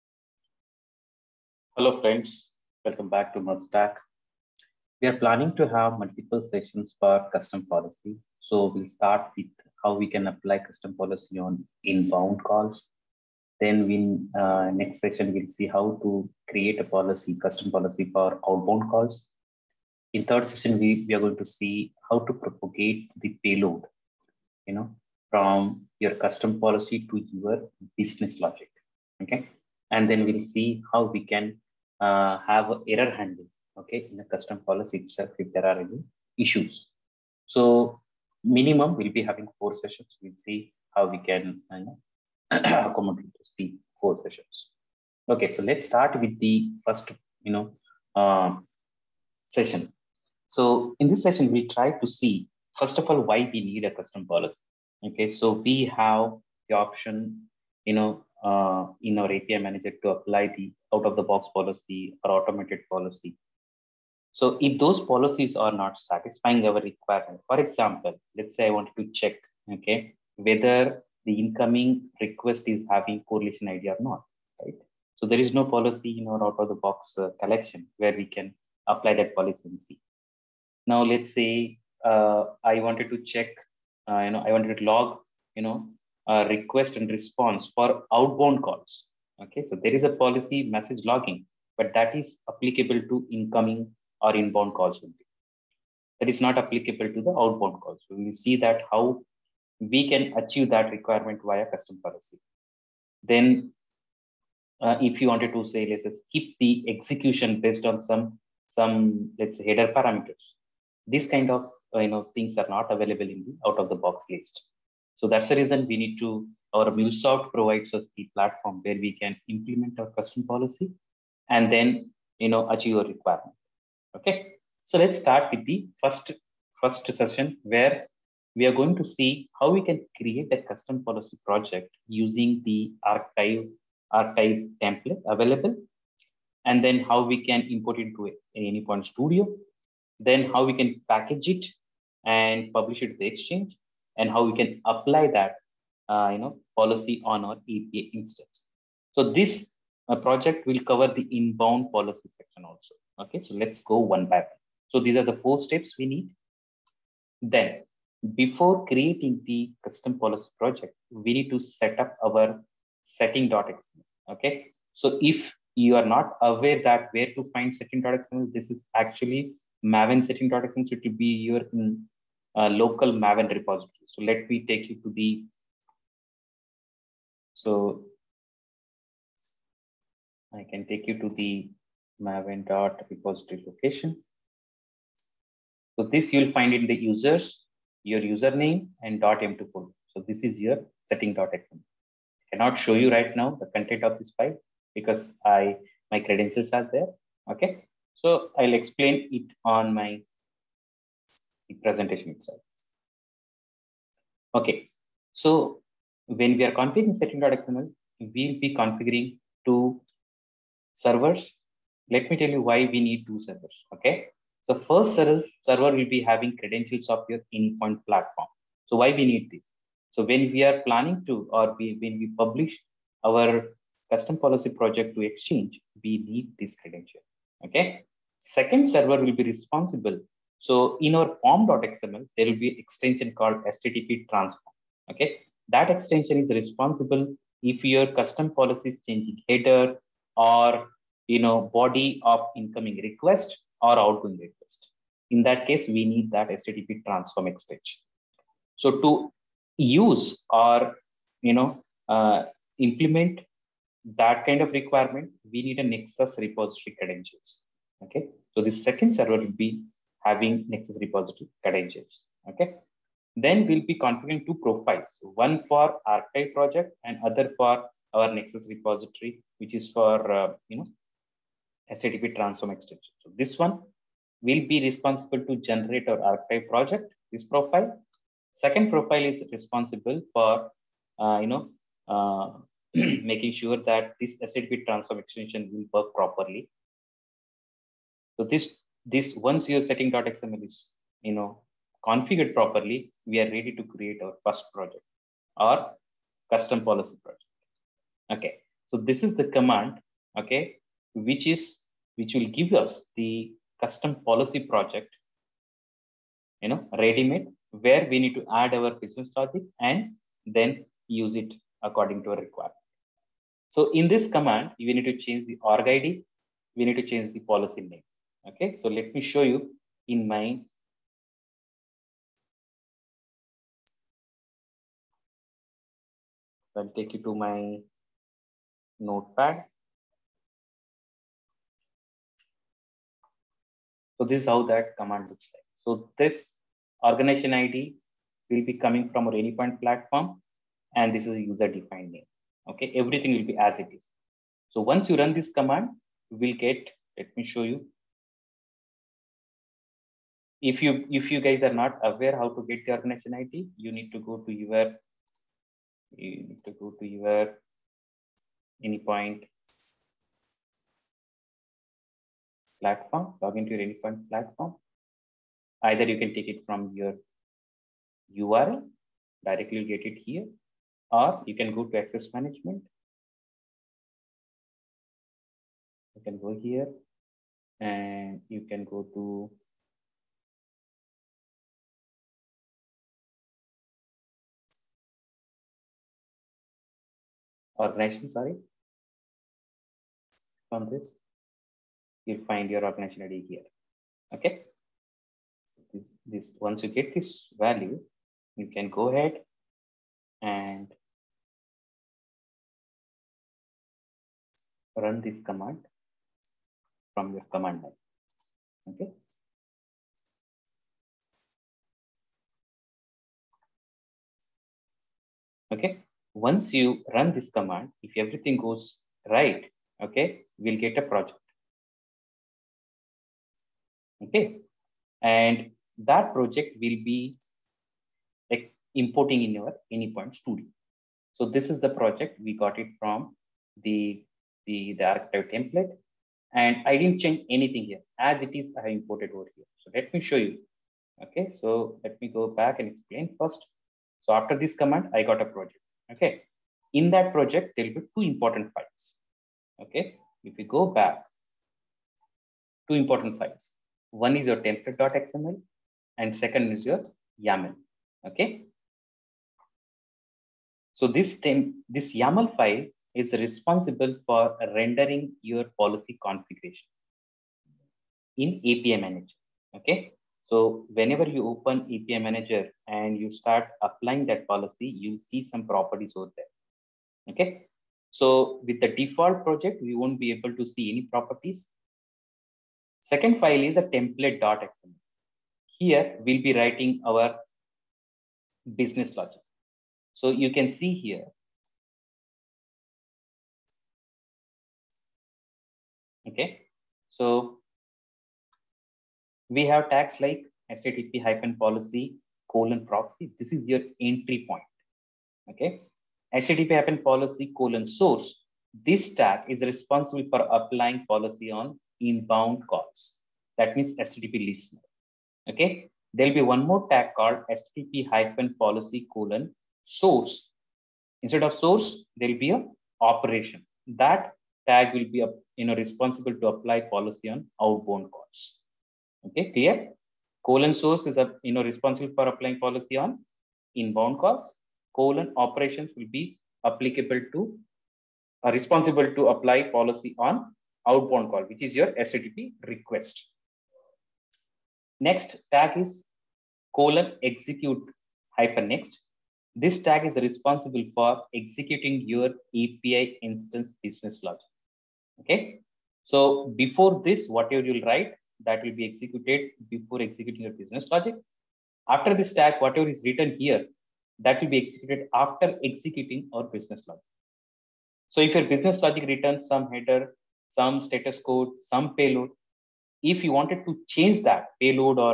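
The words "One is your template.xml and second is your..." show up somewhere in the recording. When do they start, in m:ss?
7:34.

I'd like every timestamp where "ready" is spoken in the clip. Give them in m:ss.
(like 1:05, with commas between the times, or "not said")
4:53, 5:06.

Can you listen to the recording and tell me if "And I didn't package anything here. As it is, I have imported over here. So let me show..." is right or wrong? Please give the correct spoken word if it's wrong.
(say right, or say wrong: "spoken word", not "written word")
wrong: "change", not "package".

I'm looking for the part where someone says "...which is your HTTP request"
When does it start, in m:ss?
9:01.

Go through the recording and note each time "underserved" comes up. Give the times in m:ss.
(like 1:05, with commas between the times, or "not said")
not said.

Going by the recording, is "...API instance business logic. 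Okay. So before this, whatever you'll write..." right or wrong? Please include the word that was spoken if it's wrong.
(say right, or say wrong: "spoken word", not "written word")
right.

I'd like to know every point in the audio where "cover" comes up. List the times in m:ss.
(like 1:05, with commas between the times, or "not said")
2:30.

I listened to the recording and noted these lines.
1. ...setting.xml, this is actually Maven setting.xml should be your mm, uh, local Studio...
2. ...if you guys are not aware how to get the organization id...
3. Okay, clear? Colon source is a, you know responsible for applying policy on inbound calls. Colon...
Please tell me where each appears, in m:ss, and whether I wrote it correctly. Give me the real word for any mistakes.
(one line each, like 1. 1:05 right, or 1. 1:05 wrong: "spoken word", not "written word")
1. 2:47 wrong: "Maven", not "Studio"
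2. 5:51 right
3. 8:49 right.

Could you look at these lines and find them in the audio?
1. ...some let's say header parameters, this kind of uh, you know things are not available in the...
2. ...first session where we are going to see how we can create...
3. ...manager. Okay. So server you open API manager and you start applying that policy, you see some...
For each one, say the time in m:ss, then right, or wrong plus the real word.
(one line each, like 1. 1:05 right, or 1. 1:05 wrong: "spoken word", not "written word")
1. 1:48 right
2. 2:06 right
3. 7:48 wrong: "whenever", not "server".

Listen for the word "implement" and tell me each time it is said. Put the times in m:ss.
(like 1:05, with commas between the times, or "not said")
1:59, 4:12.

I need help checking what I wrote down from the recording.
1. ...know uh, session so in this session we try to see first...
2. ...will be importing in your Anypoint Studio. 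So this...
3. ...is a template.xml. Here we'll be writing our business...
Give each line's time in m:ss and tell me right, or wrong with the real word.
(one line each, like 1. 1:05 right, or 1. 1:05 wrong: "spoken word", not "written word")
1. 0:47 right
2. 7:06 right
3. 8:03 right.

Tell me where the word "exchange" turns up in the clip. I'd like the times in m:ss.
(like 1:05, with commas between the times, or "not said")
2:23, 3:45.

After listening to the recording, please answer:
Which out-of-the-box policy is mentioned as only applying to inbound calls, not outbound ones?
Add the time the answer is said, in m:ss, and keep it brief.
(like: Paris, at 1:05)
message logging, at 1:30.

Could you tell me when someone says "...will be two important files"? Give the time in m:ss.
7:27.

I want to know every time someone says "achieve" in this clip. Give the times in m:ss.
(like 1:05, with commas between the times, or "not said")
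1:40, 2:02.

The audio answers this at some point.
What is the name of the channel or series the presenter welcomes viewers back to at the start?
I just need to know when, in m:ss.
0:03.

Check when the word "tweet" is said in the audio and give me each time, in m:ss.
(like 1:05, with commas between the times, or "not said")
not said.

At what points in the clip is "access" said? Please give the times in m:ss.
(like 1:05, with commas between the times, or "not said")
6:12.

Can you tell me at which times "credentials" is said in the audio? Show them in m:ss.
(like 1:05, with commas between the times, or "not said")
3:16, 3:36, 3:46, 4:16, 4:21.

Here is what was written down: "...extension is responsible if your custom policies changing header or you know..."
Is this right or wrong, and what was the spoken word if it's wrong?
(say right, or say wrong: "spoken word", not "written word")
right.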